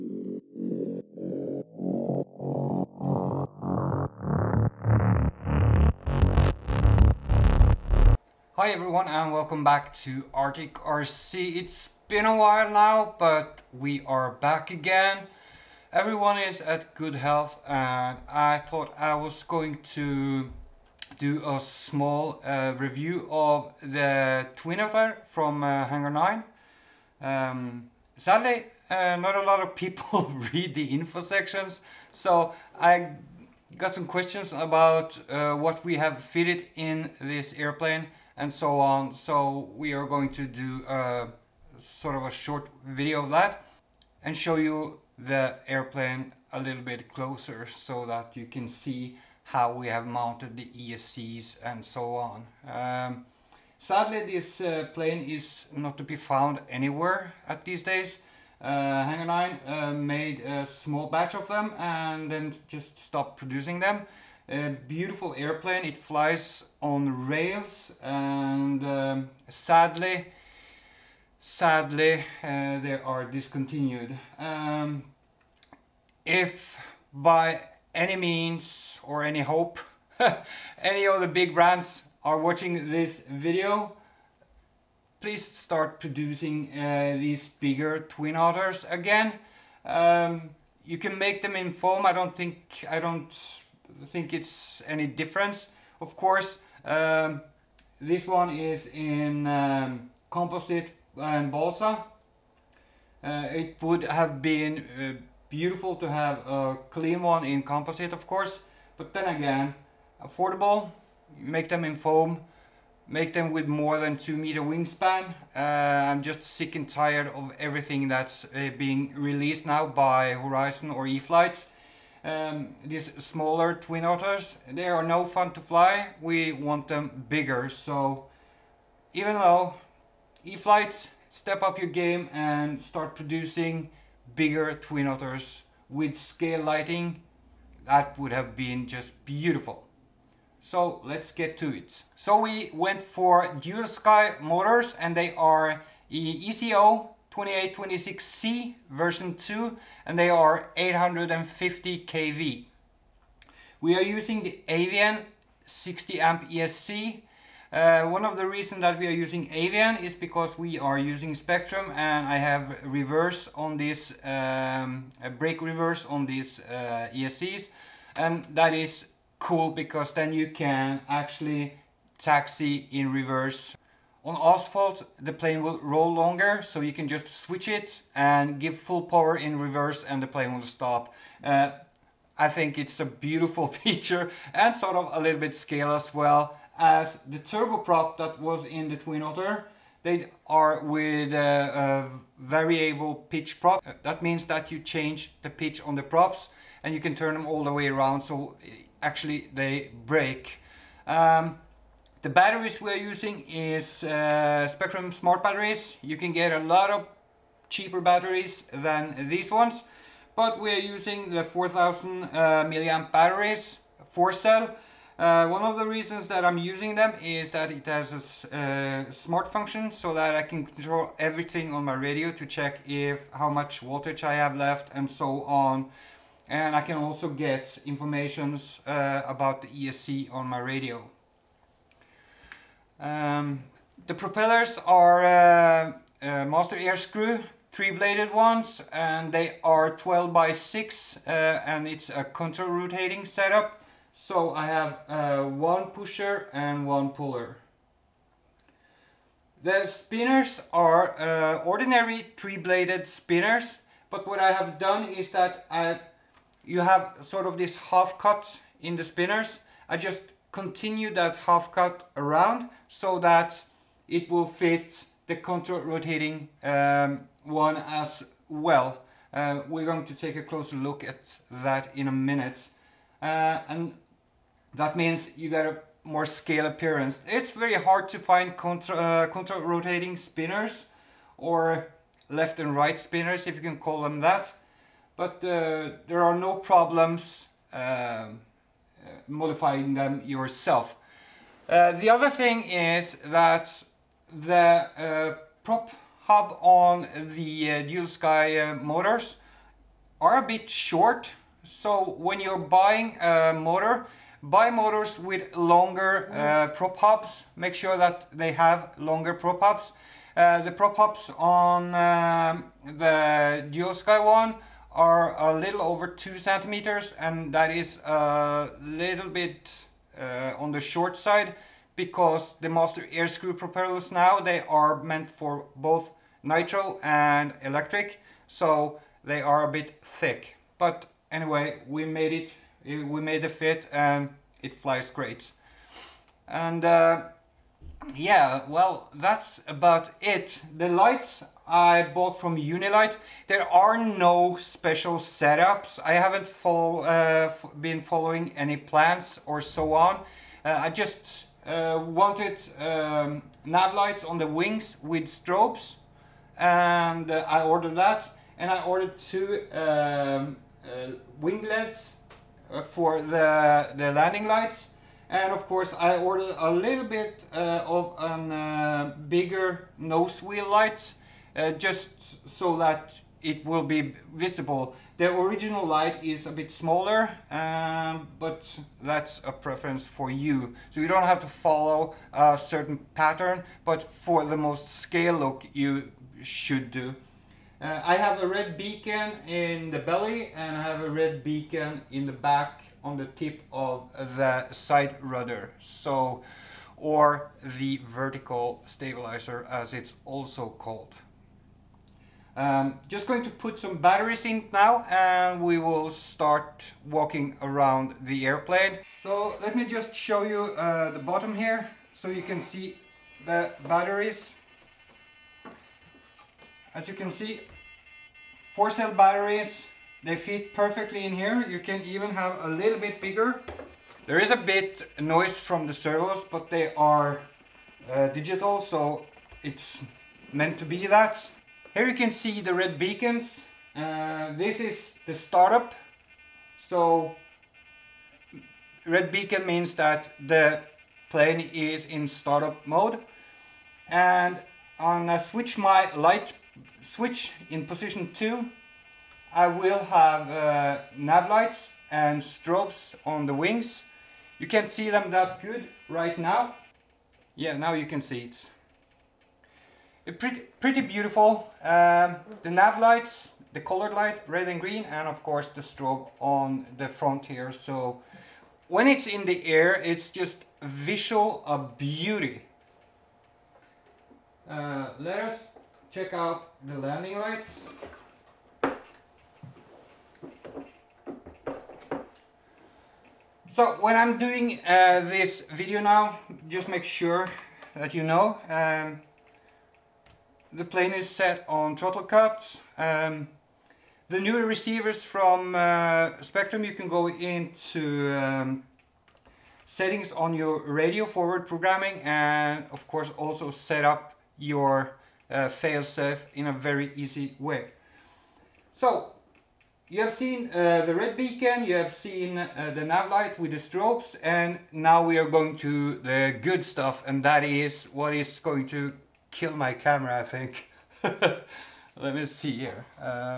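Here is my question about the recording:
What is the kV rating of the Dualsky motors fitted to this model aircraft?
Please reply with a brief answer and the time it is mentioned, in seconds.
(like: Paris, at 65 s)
850 kV, at 150 s.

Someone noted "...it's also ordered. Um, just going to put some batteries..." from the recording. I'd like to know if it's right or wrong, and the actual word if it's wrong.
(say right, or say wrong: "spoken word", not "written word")
wrong: "called", not "ordered".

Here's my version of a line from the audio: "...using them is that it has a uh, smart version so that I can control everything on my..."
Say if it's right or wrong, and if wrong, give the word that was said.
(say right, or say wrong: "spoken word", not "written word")
wrong: "function", not "version".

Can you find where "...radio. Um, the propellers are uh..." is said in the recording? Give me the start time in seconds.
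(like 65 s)
230 s.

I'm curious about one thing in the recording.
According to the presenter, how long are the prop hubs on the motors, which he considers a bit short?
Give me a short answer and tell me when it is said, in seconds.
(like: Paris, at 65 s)
a little over 2 centimeters, at 315 s.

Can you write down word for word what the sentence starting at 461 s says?
Um, the nav lights, the colored light, red and green, and of course the strobe on the front here.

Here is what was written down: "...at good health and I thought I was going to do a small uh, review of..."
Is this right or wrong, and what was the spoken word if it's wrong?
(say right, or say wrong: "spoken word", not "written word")
right.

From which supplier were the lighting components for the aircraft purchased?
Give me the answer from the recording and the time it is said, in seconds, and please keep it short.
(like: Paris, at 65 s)
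UniLight, at 342 s.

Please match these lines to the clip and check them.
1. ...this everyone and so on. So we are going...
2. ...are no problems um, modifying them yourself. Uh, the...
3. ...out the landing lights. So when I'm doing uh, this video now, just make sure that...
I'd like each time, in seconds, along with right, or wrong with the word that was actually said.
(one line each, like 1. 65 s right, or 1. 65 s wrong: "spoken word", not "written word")
1. 37 s wrong: "airplane", not "everyone"
2. 286 s right
3. 476 s right.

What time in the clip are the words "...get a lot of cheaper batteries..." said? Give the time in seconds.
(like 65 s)
206 s.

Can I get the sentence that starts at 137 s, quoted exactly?
That would have been just beautiful.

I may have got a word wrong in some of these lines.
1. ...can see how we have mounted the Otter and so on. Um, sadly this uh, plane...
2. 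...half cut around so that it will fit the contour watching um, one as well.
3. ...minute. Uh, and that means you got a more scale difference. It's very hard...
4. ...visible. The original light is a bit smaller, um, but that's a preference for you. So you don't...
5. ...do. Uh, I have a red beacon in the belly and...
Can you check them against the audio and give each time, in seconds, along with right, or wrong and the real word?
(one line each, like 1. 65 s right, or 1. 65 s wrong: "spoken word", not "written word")
1. 48 s wrong: "ESCs", not "Otter"
2. 261 s wrong: "rotating", not "watching"
3. 272 s wrong: "appearance", not "difference"
4. 374 s right
5. 386 s right.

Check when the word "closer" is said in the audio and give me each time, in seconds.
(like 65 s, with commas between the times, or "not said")
47 s, 270 s.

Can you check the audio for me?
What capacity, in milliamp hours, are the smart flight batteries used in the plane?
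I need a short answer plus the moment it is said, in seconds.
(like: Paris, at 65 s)
4000, at 211 s.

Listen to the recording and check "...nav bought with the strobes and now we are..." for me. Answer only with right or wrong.
wrong.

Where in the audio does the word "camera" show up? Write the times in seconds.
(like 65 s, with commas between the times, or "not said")
519 s.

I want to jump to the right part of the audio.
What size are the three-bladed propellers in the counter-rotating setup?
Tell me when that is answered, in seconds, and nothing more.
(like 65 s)
239 s.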